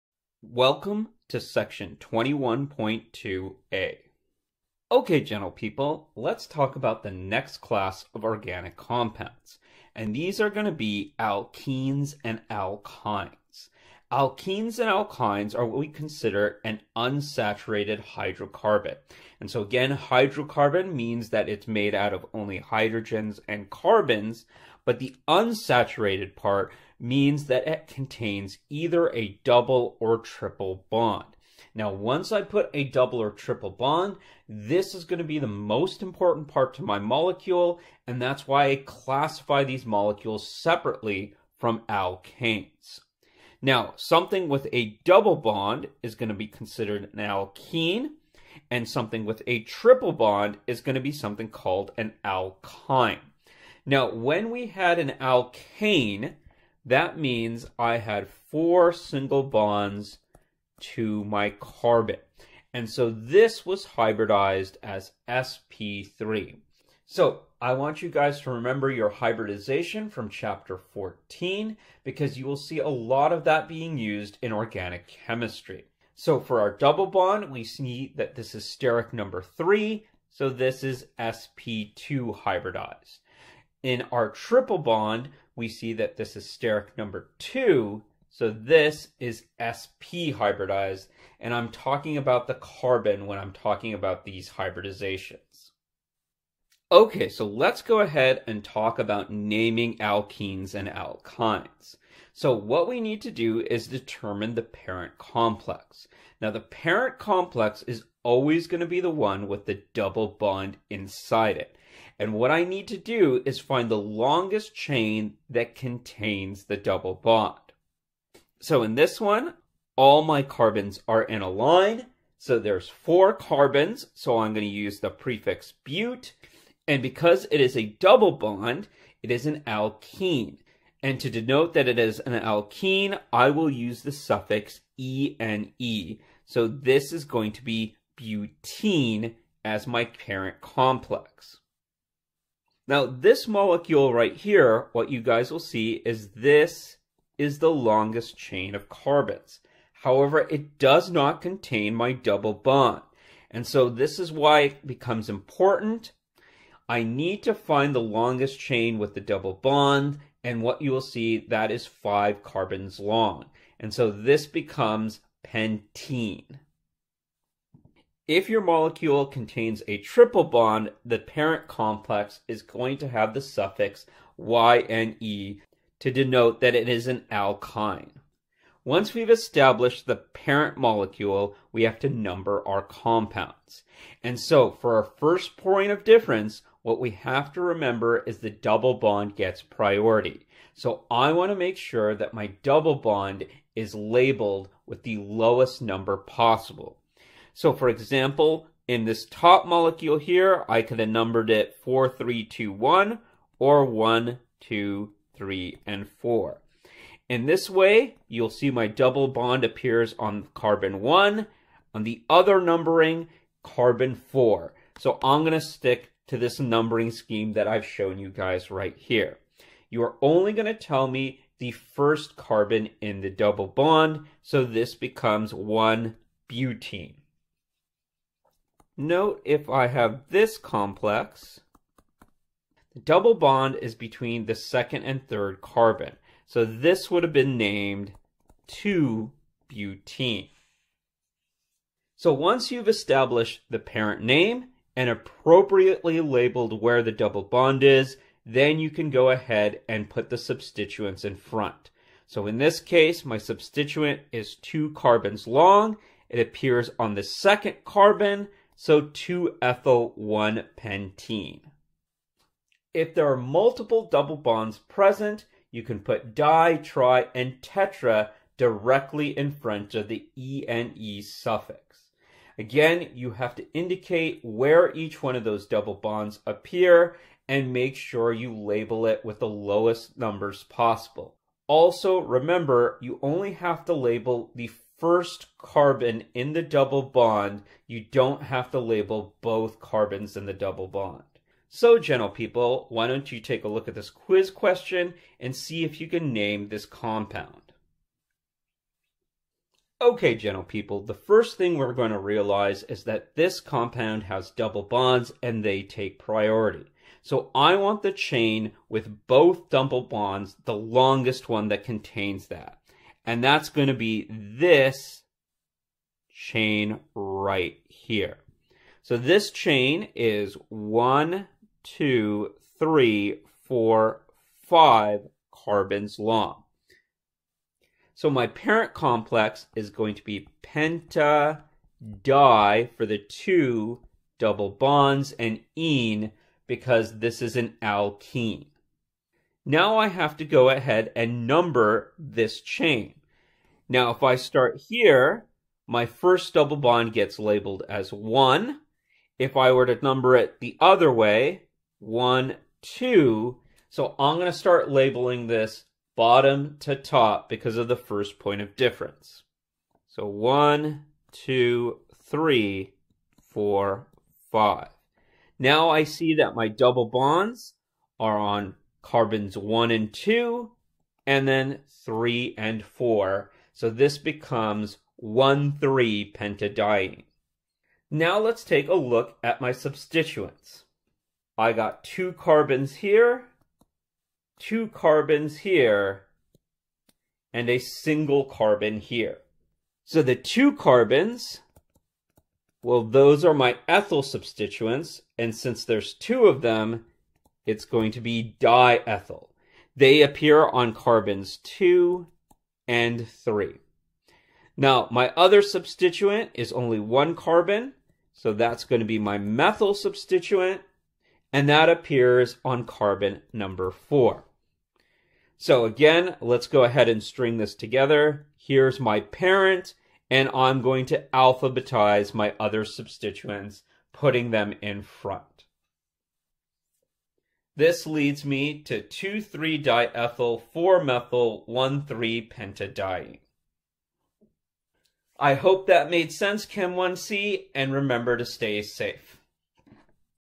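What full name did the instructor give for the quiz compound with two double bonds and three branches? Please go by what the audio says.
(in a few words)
2,3-diethyl-4-methyl-1,3-pentadiene.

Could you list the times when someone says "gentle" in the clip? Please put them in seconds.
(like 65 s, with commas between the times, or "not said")
5 s, 291 s, 300 s.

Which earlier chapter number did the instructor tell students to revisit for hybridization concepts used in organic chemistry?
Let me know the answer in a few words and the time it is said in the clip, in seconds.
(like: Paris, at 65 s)
14, at 70 s.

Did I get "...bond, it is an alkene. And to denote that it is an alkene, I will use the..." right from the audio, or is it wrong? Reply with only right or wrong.
right.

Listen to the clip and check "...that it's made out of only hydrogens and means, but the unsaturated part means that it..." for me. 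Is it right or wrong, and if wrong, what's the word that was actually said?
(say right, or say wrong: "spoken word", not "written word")
wrong: "carbons", not "means".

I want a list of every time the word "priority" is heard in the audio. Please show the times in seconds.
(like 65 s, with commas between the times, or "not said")
189 s, 306 s.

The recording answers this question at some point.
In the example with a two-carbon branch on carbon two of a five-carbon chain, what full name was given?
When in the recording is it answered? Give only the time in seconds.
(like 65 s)
258 s.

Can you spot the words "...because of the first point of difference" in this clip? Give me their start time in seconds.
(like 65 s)
357 s.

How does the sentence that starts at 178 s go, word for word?
Once we've established the parent molecule, we have to number our compounds.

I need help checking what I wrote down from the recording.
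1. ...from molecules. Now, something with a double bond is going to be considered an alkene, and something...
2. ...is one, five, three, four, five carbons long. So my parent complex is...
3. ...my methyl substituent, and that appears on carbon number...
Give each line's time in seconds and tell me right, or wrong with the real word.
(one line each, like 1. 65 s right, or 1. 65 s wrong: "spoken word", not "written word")
1. 41 s wrong: "alkanes", not "molecules"
2. 320 s wrong: "two", not "five"
3. 409 s right.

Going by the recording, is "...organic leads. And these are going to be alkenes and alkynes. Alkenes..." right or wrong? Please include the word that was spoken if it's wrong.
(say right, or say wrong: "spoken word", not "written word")
wrong: "compounds", not "leads".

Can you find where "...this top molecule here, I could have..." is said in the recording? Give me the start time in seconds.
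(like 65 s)
199 s.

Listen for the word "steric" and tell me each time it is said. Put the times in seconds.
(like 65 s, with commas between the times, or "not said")
78 s, 86 s.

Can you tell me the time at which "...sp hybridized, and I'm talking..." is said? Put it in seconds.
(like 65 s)
89 s.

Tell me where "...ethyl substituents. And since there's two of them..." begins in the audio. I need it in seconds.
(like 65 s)
393 s.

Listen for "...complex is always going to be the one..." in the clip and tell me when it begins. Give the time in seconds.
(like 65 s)
107 s.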